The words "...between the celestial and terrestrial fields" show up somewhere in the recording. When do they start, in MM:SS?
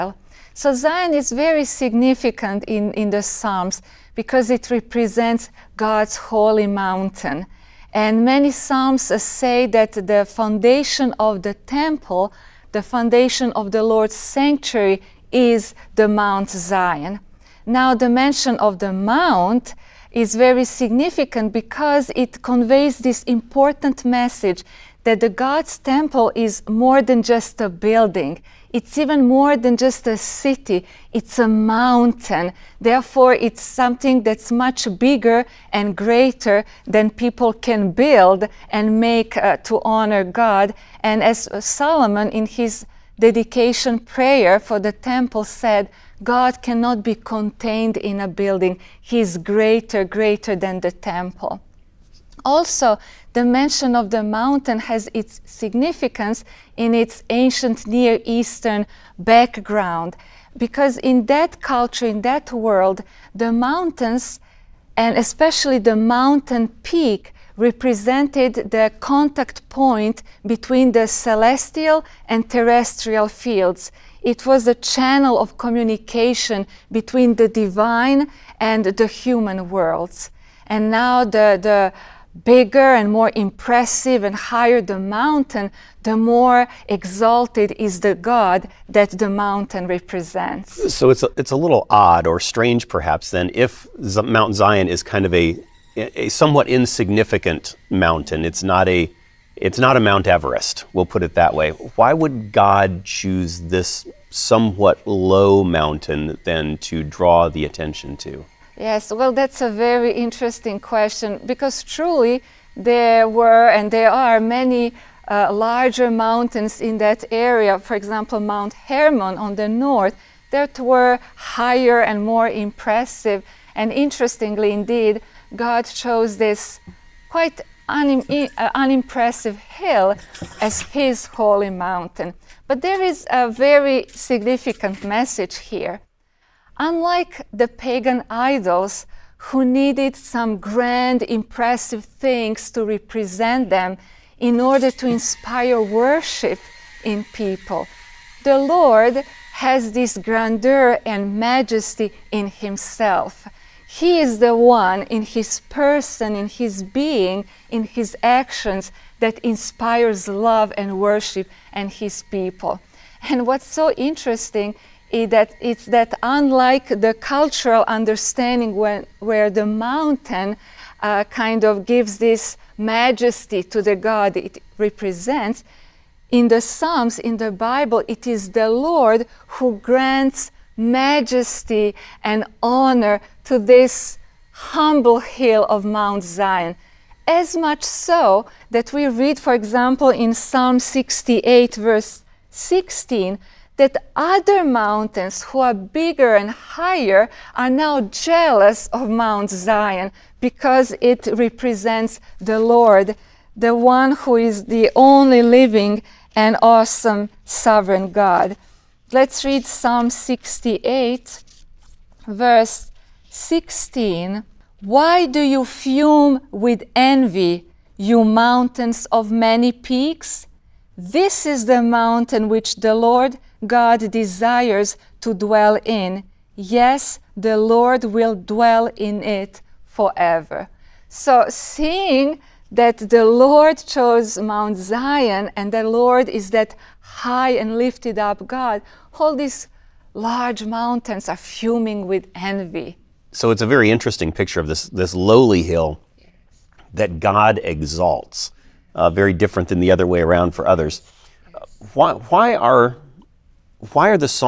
01:10.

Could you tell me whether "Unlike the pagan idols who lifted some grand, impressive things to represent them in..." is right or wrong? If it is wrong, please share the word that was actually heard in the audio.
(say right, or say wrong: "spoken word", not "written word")
wrong: "needed", not "lifted".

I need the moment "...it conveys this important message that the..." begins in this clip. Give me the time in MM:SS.
00:22.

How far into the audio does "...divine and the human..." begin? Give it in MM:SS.
01:17.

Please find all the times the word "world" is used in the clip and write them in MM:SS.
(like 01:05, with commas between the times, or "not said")
01:02, 01:19.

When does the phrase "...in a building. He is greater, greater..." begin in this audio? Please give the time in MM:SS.
00:47.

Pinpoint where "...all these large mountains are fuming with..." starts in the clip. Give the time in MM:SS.
03:59.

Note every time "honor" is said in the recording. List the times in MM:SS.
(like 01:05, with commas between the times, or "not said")
00:39, 03:02.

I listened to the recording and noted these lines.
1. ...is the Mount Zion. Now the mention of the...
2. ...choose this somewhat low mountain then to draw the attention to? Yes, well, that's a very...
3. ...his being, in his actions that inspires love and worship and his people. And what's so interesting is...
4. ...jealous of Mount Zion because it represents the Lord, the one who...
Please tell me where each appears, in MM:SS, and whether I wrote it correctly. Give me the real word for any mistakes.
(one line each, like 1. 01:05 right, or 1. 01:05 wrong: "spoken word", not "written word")
1. 00:15 right
2. 01:43 right
3. 02:36 right
4. 03:18 right.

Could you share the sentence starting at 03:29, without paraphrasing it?
Let's read Psalm 68, verse 16.